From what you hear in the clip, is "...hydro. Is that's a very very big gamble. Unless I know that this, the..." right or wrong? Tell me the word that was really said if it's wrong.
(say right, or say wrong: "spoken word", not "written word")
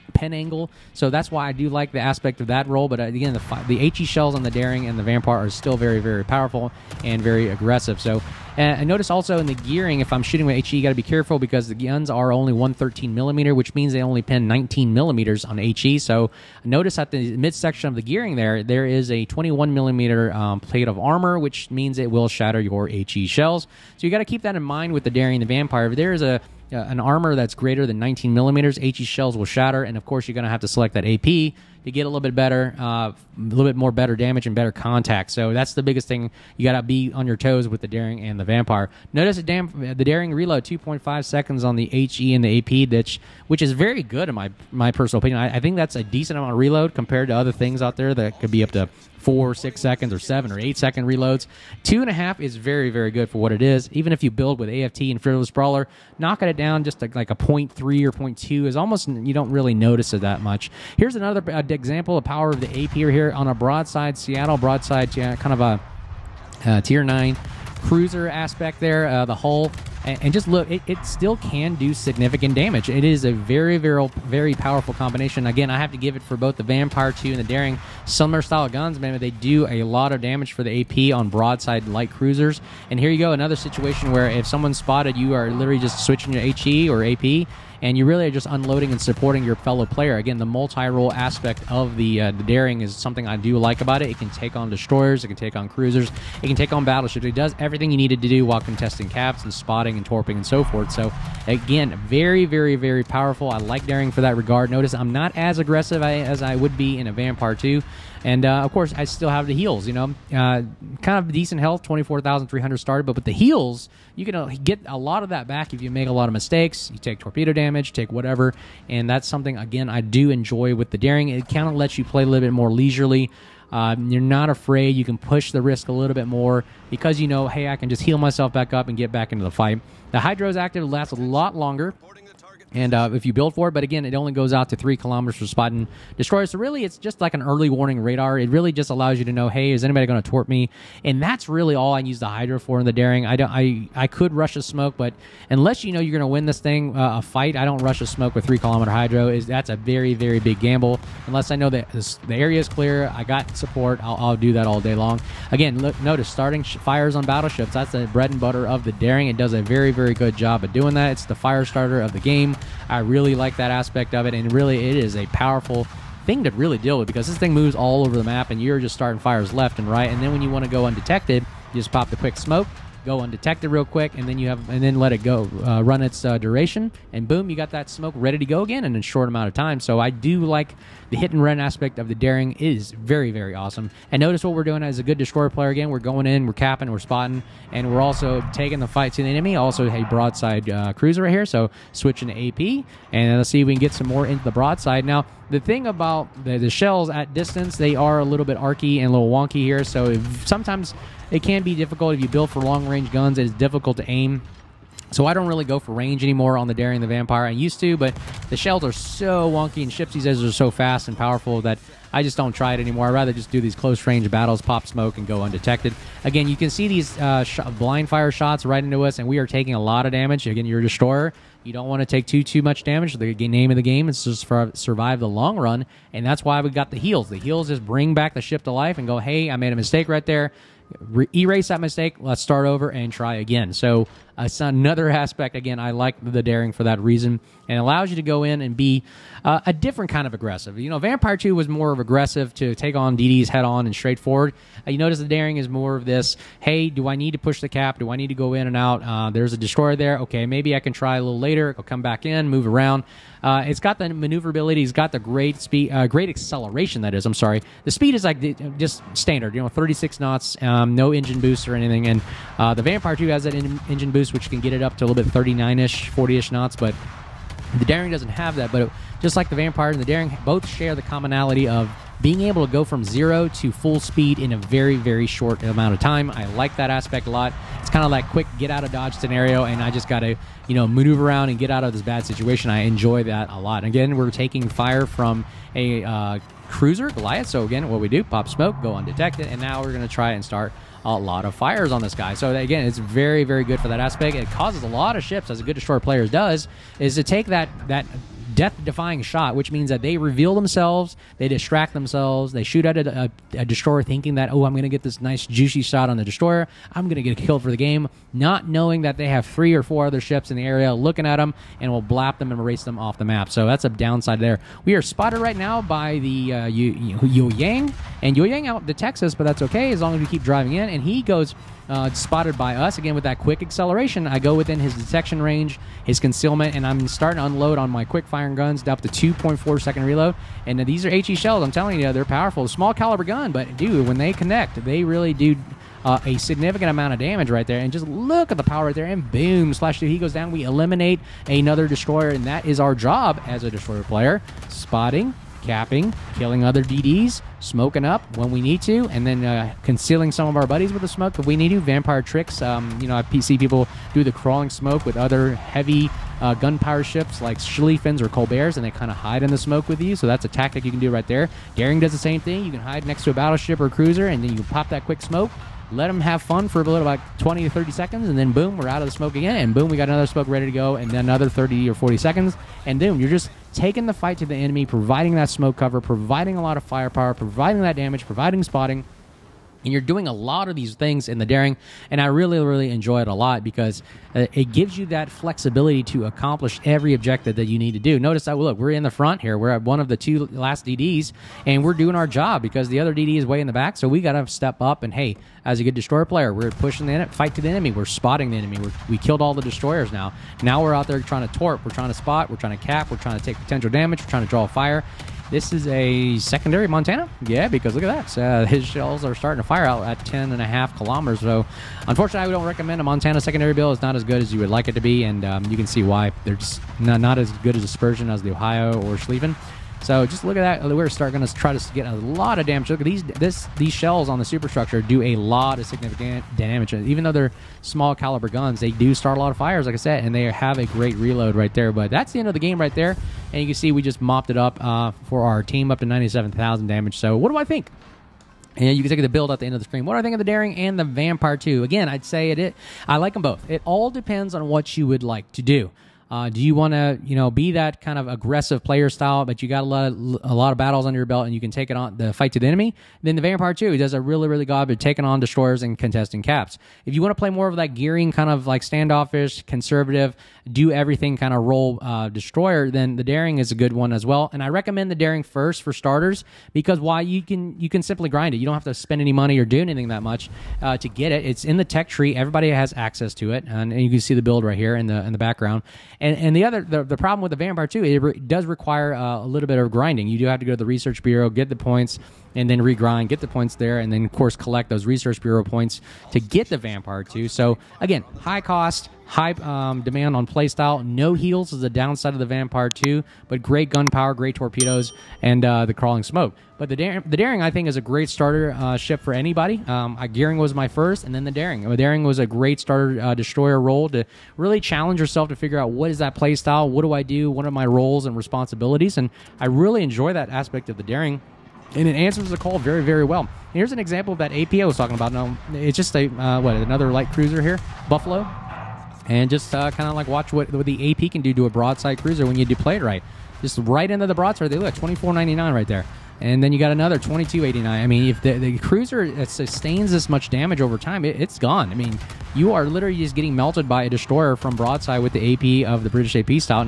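right.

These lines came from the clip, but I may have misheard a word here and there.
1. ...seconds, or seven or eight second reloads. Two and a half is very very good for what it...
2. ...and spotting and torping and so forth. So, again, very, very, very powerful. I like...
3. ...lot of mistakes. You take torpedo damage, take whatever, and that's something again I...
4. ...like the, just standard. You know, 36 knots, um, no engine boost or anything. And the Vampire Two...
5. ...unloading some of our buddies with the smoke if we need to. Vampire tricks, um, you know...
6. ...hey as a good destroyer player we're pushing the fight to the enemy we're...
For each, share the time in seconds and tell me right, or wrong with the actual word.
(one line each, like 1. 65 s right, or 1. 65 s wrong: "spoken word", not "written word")
1. 49 s right
2. 99 s right
3. 116 s right
4. 258 s right
5. 349 s wrong: "concealing", not "unloading"
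6. 395 s right.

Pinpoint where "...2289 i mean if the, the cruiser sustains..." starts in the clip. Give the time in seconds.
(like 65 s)
527 s.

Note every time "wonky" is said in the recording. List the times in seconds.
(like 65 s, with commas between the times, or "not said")
199 s, 209 s.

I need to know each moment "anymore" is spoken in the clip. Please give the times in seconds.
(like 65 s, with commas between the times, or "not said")
206 s, 212 s.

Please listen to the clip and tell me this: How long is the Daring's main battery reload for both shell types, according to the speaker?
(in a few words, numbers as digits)
2.5 seconds.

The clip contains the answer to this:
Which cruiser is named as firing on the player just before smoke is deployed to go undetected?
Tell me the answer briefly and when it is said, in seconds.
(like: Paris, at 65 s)
Goliath, at 287 s.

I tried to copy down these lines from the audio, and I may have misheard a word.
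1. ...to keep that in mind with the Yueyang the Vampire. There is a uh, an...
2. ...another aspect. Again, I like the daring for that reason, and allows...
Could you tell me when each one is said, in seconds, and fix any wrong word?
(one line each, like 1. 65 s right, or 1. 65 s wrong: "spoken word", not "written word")
1. 24 s wrong: "Daring", not "Yueyang"
2. 234 s right.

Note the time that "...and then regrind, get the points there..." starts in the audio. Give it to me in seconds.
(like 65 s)
482 s.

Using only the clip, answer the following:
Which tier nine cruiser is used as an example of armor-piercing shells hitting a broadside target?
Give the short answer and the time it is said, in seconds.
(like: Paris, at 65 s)
Seattle, at 64 s.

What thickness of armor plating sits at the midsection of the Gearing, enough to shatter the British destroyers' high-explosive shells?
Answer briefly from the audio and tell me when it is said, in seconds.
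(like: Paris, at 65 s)
21 millimeter, at 19 s.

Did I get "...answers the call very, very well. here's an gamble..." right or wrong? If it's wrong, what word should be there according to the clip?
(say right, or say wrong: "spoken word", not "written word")
wrong: "example", not "gamble".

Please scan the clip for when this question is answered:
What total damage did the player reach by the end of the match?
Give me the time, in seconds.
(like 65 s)
436 s.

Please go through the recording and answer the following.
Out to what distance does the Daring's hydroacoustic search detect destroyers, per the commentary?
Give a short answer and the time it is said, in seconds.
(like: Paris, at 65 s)
3 kilometers, at 134 s.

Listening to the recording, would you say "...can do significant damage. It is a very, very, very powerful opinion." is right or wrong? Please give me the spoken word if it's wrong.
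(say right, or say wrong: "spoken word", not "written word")
wrong: "combination", not "opinion".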